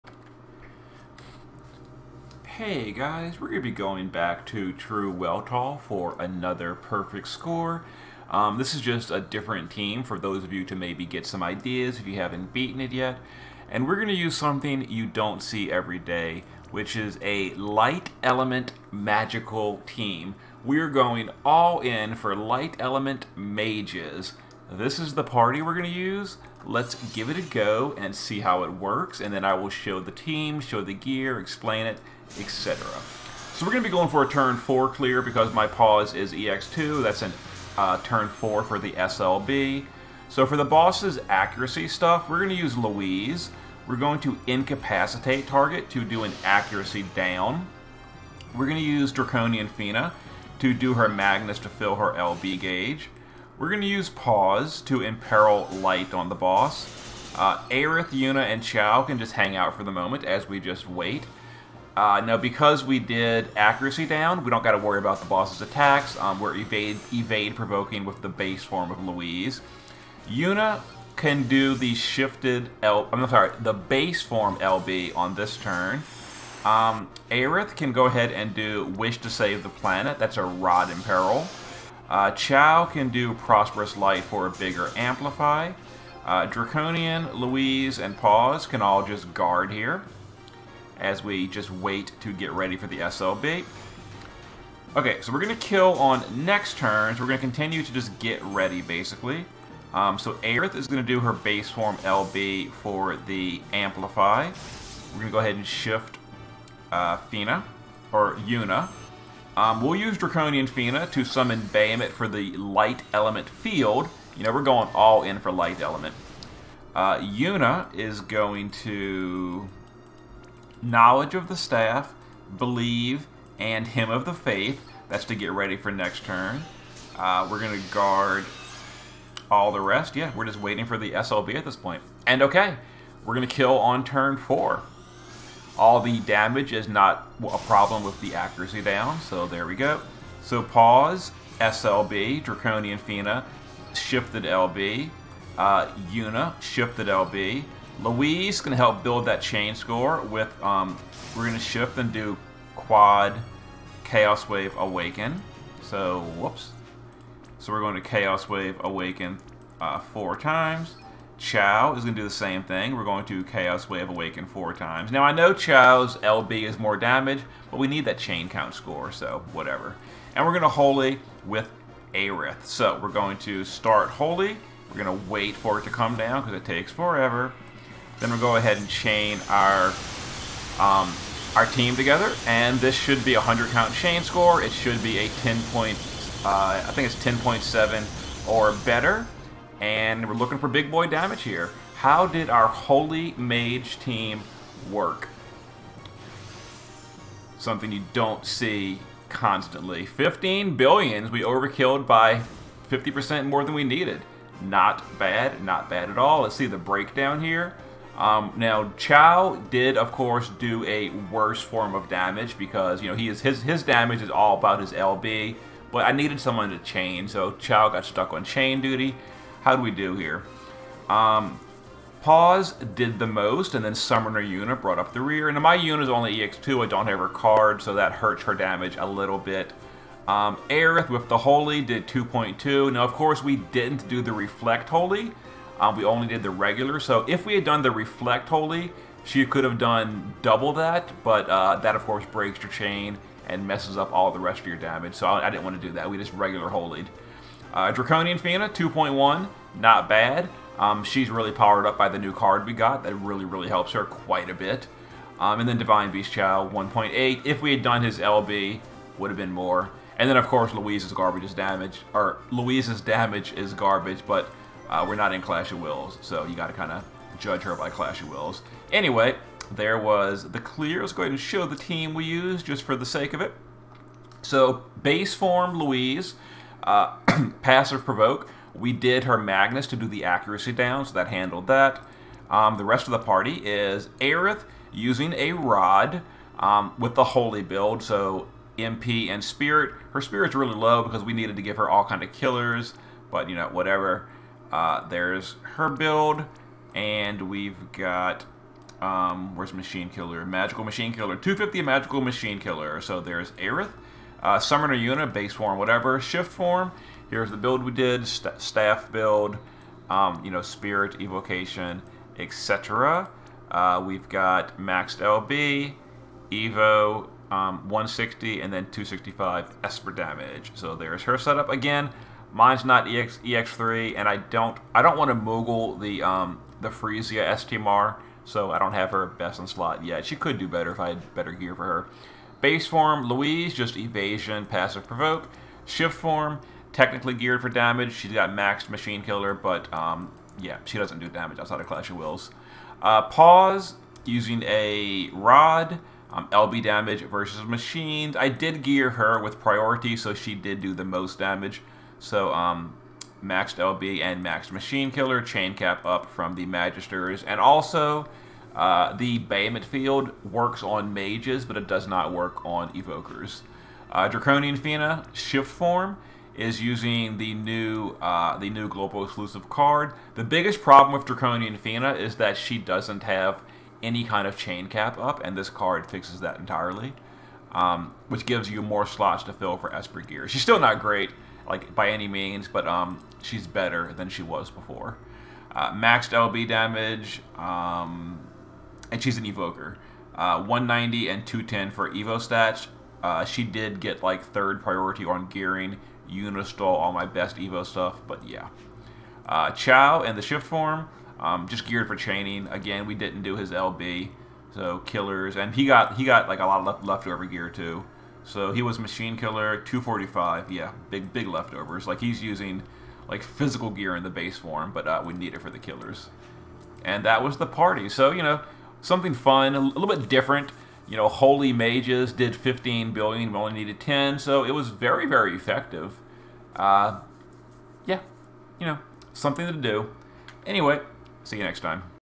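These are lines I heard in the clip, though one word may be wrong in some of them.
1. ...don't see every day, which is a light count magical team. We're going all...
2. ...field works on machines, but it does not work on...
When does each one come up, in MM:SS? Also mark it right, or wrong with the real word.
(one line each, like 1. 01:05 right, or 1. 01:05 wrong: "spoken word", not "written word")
1. 00:15 wrong: "element", not "count"
2. 05:59 wrong: "mages", not "machines".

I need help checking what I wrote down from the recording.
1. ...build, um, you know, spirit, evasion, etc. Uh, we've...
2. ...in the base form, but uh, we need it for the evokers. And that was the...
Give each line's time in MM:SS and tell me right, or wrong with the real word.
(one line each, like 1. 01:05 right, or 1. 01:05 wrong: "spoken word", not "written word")
1. 05:09 wrong: "evocation", not "evasion"
2. 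06:54 wrong: "killers", not "evokers".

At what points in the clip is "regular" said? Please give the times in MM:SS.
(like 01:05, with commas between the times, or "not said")
03:56, 04:06.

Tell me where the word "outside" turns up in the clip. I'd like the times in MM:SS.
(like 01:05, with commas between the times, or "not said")
05:41.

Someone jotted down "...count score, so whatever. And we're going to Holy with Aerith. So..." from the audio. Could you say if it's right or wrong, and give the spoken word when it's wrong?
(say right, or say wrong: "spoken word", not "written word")
right.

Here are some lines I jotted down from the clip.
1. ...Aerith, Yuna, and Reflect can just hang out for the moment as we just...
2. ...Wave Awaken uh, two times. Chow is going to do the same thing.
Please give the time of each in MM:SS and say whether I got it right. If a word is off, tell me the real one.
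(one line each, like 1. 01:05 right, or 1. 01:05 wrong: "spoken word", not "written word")
1. 00:57 wrong: "Chow", not "Reflect"
2. 02:38 wrong: "four", not "two".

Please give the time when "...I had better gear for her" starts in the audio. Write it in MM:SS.
05:30.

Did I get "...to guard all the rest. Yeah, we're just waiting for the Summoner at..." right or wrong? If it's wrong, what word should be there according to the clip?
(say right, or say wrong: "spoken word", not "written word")
wrong: "SLB", not "Summoner".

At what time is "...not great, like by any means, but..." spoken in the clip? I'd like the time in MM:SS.
06:20.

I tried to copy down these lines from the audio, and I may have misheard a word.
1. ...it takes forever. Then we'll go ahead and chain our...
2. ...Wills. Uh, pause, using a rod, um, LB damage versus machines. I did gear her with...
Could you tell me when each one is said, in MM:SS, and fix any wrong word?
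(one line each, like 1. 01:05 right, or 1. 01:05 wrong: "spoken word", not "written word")
1. 02:56 right
2. 05:42 right.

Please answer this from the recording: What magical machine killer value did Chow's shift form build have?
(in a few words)
245.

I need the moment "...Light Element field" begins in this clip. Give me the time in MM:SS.
01:52.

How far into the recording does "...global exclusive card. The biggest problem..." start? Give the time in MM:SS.
06:08.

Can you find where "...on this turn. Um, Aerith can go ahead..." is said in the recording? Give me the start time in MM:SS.
01:15.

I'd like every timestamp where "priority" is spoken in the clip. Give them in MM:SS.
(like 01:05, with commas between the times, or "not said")
05:49, 06:34.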